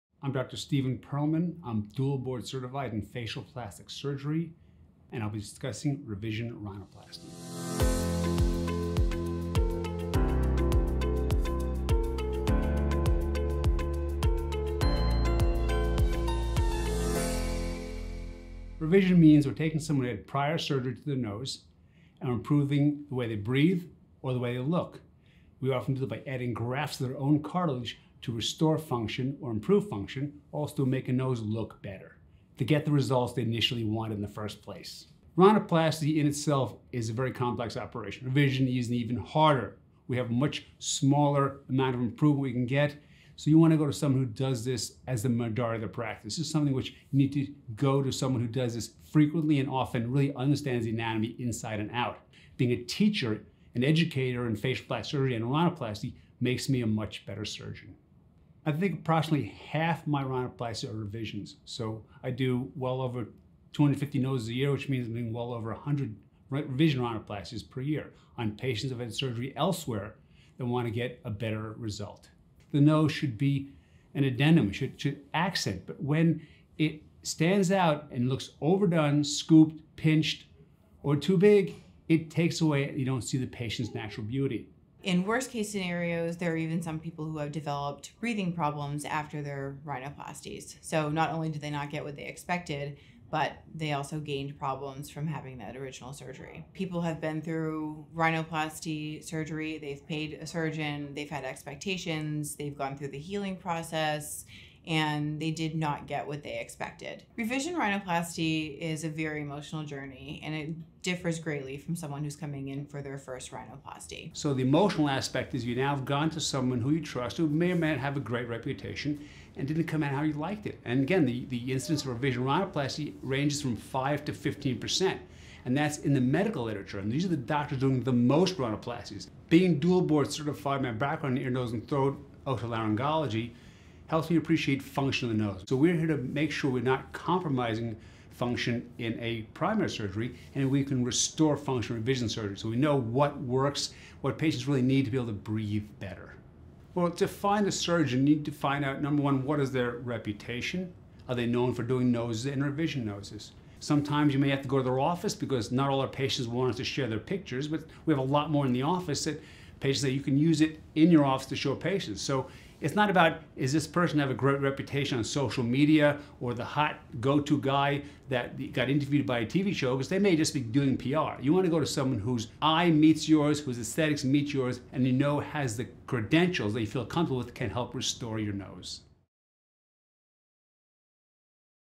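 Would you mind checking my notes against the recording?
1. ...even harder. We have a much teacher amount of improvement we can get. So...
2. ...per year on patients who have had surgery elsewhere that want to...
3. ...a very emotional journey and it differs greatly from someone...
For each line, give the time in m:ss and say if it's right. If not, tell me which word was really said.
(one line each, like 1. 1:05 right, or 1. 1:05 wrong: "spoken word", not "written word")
1. 0:38 wrong: "smaller", not "teacher"
2. 1:07 right
3. 1:49 right.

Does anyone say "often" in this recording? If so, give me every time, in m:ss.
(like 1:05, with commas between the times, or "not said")
0:25, 0:49.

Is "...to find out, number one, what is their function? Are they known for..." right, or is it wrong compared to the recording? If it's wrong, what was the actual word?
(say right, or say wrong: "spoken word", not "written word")
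wrong: "reputation", not "function".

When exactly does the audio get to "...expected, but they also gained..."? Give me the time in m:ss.
1:32.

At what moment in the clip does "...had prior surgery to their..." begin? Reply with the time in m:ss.
0:20.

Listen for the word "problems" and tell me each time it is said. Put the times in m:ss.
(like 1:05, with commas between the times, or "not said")
1:28, 1:34.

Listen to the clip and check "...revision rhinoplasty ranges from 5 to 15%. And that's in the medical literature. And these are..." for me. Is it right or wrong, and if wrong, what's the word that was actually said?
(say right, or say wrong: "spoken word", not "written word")
right.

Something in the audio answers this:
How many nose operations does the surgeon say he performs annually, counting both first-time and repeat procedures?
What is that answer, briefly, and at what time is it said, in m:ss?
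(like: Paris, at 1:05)
over 250, at 1:02.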